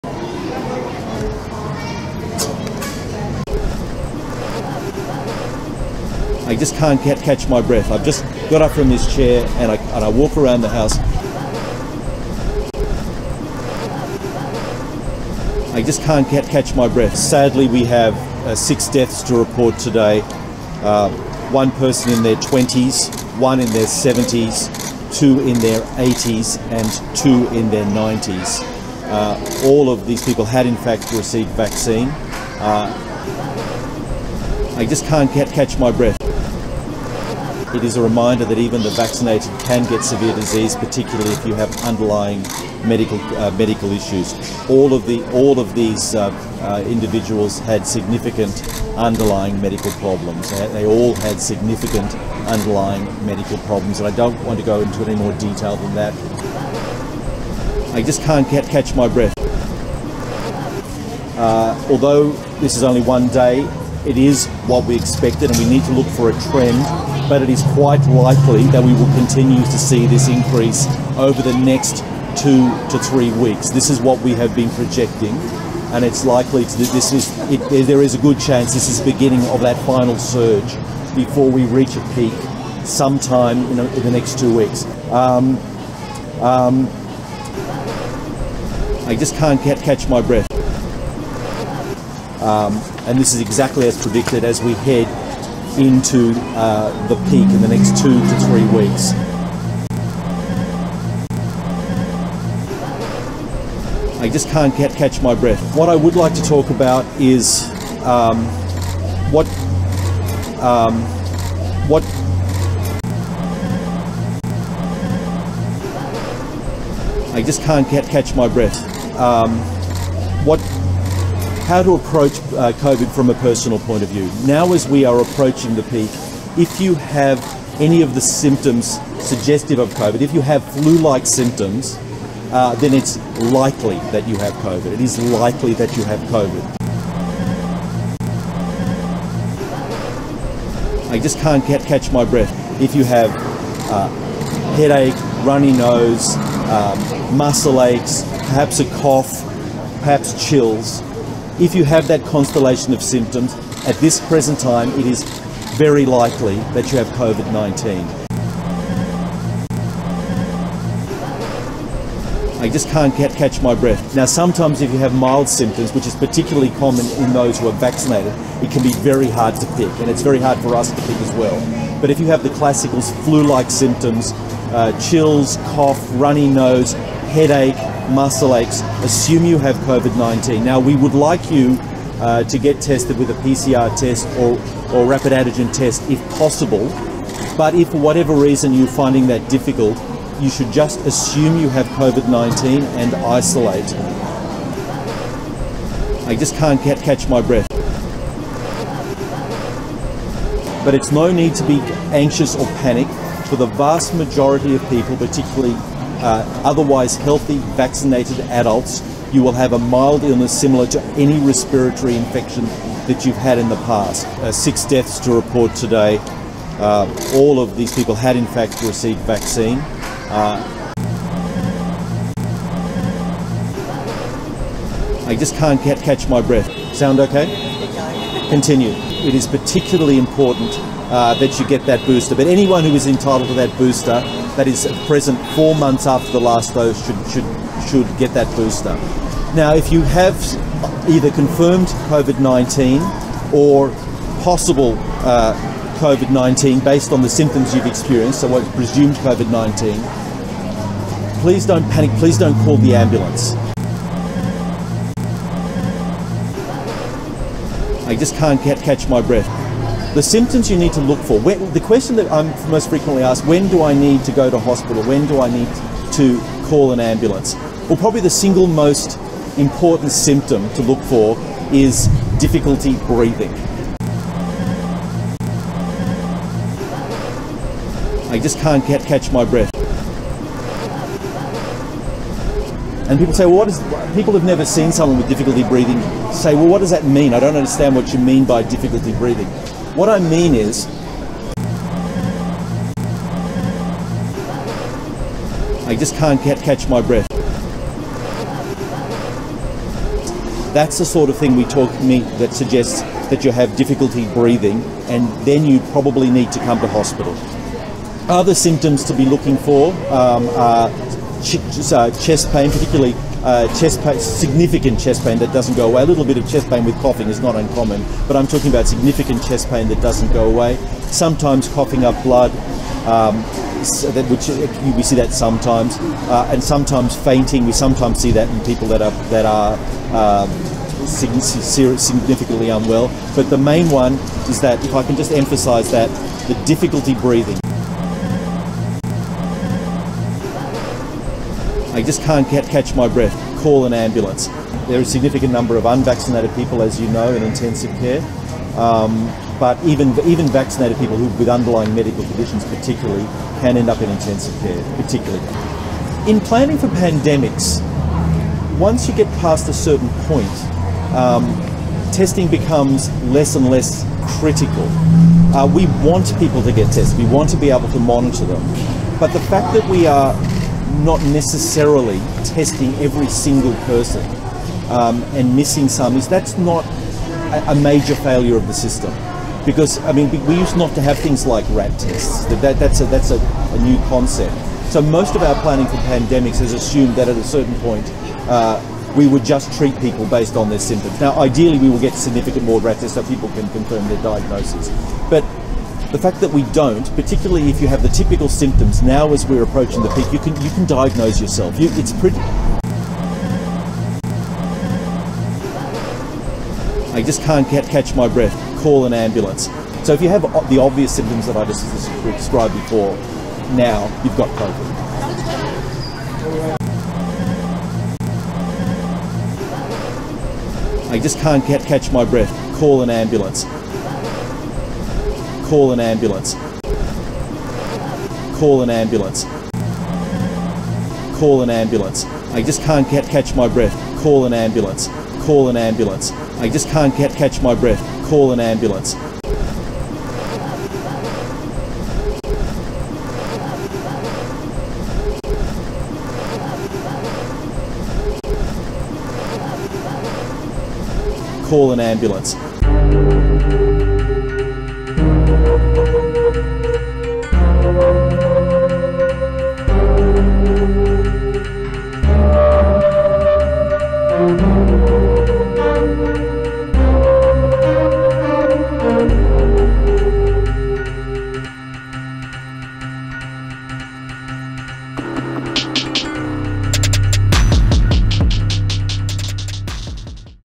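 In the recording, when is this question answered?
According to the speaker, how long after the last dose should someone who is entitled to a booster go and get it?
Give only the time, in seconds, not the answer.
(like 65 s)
235 s.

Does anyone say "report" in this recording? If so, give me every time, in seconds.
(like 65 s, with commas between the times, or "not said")
19 s, 215 s.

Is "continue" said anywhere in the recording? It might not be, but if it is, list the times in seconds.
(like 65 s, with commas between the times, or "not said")
69 s, 228 s.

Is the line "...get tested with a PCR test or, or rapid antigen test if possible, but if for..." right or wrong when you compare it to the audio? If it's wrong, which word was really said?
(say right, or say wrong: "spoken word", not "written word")
right.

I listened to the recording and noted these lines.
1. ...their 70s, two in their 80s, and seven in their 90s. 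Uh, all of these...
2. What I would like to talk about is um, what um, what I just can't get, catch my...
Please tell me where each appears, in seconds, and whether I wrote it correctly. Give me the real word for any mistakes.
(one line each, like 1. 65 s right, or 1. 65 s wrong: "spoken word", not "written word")
1. 23 s wrong: "two", not "seven"
2. 105 s right.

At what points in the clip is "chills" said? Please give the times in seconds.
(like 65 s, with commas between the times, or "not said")
150 s, 174 s.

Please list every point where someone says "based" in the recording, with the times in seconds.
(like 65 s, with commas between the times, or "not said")
246 s, 390 s.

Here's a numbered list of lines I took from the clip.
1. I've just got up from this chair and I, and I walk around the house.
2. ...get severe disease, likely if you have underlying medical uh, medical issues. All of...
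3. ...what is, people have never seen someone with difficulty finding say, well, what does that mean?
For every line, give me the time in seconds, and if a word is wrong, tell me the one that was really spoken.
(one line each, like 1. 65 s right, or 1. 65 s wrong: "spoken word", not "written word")
1. 7 s right
2. 39 s wrong: "particularly", not "likely"
3. 283 s wrong: "breathing", not "finding".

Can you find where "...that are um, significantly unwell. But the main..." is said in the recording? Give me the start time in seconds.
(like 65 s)
329 s.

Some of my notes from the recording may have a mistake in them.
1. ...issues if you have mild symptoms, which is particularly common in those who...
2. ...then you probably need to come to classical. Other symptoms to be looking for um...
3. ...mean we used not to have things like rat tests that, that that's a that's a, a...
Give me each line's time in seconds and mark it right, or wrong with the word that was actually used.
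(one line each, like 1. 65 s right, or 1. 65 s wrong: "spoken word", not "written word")
1. 164 s wrong: "sometimes", not "issues"
2. 305 s wrong: "hospital", not "classical"
3. 380 s right.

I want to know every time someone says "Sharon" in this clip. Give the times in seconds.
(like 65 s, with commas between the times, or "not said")
not said.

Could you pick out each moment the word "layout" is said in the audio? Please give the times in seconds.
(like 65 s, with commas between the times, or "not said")
not said.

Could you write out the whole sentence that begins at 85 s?
Um, um, I just can't catch my breath.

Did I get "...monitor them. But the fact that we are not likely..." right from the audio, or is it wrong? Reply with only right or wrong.
wrong.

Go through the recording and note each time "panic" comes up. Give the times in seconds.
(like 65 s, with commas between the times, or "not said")
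202 s, 251 s.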